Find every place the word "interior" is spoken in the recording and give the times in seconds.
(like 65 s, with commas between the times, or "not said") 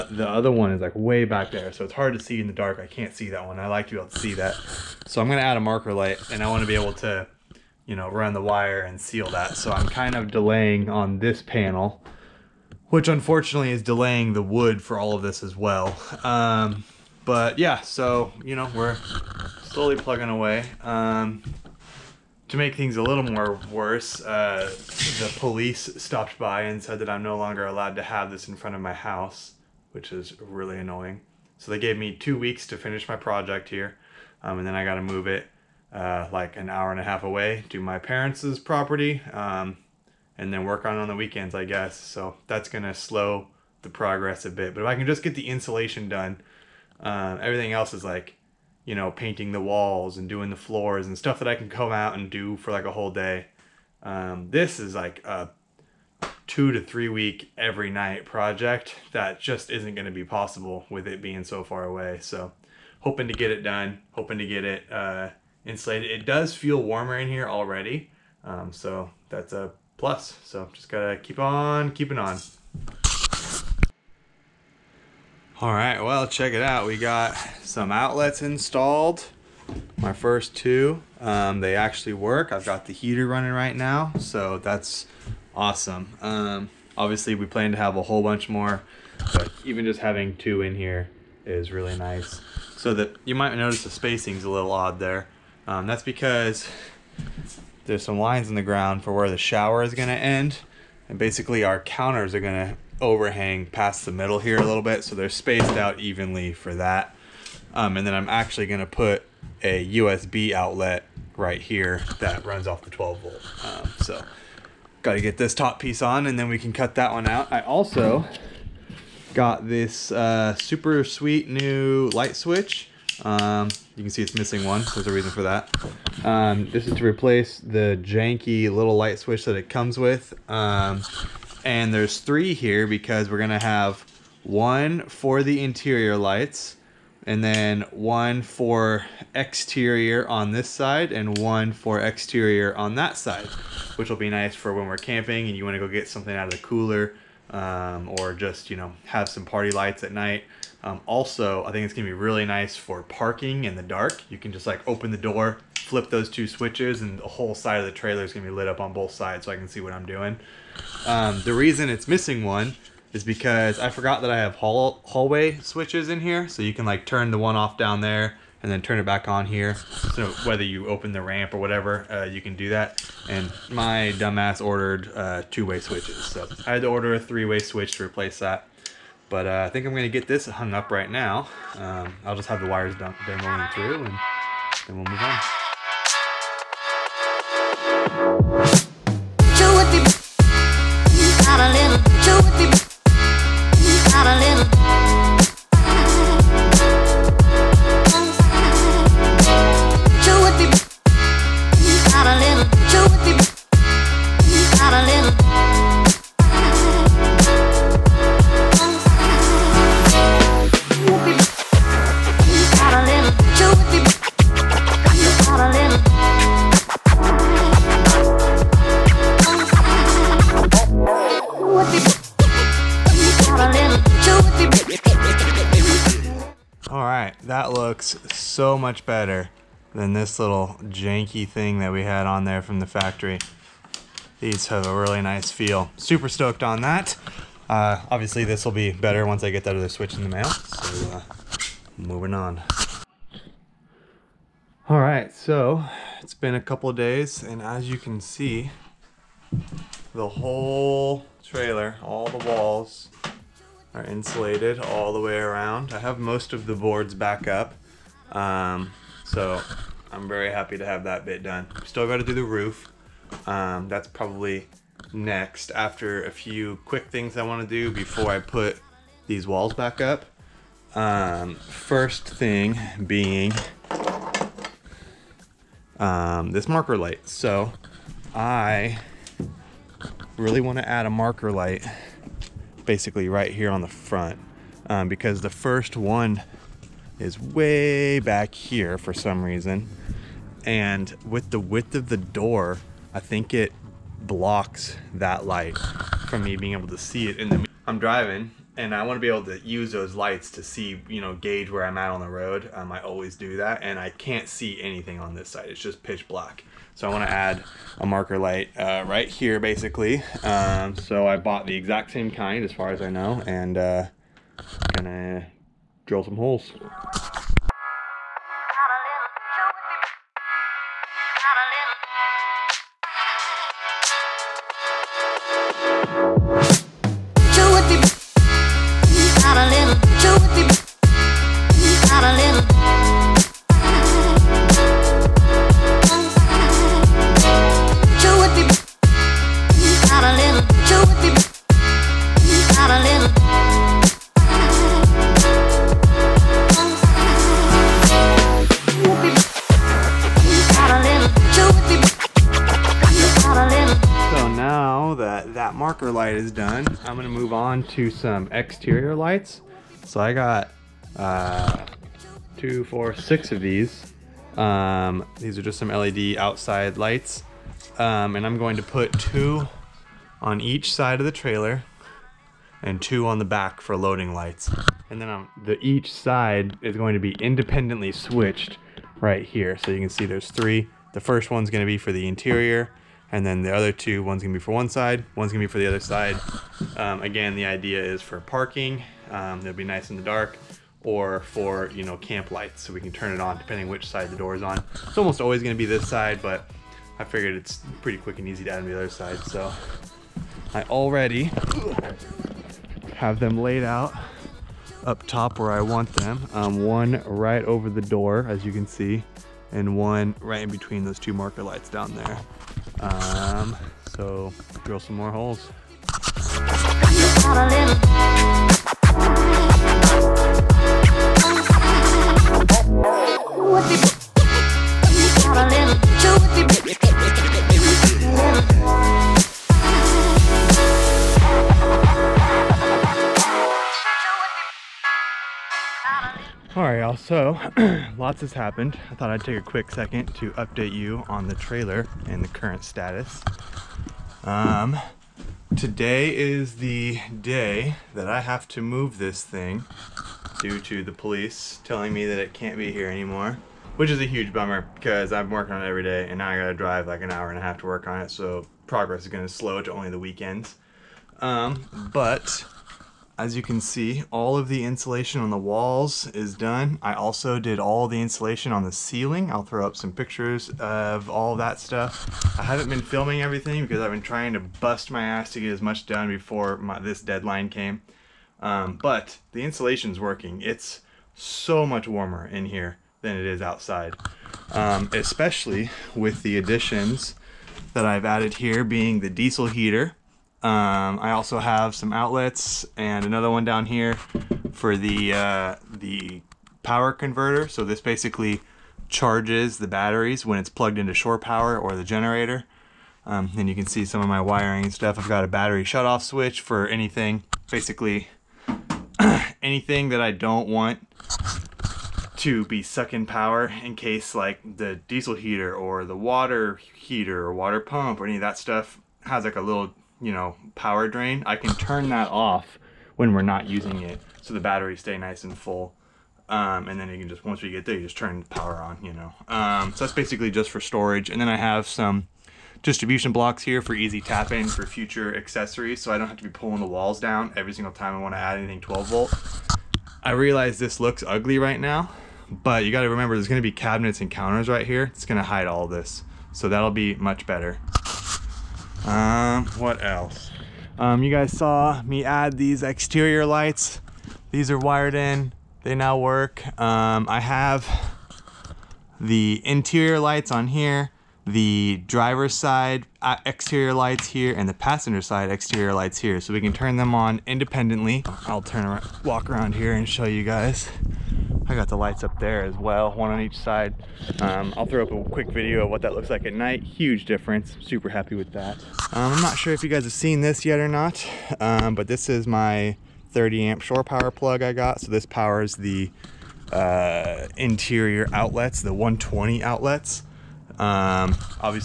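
135 s, 382 s, 559 s, 587 s.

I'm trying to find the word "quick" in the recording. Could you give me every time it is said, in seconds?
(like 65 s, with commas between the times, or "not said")
266 s, 398 s, 439 s, 575 s.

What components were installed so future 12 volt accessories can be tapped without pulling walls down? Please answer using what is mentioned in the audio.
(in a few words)
Distribution blocks.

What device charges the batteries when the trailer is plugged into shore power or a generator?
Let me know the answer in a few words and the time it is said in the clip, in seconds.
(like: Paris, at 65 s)
Power converter, at 496 s.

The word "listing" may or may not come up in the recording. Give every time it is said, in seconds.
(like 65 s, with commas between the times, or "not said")
not said.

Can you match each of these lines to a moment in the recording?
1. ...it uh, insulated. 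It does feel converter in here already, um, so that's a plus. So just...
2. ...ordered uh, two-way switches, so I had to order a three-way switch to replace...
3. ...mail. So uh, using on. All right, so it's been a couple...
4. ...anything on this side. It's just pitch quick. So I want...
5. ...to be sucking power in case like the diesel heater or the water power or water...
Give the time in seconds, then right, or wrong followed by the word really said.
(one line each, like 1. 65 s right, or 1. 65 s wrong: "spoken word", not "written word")
1. 64 s wrong: "warmer", not "converter"
2. 174 s right
3. 240 s wrong: "moving", not "using"
4. 304 s wrong: "black", not "quick"
5. 512 s wrong: "heater", not "power".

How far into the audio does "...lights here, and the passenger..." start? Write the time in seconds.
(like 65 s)
563 s.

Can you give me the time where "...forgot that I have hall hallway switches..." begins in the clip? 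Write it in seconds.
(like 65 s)
163 s.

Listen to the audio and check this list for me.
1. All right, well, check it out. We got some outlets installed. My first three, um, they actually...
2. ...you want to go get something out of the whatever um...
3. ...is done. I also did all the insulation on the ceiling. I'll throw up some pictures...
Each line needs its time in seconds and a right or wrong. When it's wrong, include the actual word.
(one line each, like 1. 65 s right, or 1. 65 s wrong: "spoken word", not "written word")
1. 75 s wrong: "two", not "three"
2. 145 s wrong: "cooler", not "whatever"
3. 466 s right.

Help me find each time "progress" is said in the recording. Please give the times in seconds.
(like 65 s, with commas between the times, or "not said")
43 s, 458 s.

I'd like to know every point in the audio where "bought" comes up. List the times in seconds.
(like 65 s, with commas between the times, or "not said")
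311 s.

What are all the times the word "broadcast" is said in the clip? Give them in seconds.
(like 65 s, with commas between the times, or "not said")
not said.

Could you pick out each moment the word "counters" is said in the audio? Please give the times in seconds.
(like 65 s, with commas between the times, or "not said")
101 s, 544 s.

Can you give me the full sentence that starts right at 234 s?
These have a really nice feel.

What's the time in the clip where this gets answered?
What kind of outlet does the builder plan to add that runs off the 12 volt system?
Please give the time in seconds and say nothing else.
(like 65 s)
109 s.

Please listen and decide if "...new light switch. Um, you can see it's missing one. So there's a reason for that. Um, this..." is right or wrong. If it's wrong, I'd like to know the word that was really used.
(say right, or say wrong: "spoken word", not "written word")
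right.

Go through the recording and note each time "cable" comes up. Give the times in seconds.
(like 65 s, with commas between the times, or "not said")
not said.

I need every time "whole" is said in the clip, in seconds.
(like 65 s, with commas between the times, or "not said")
52 s, 88 s, 157 s, 250 s.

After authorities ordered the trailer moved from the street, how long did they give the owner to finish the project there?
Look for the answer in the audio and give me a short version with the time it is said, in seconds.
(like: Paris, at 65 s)
2 weeks, at 32 s.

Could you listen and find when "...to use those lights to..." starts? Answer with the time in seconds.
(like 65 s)
299 s.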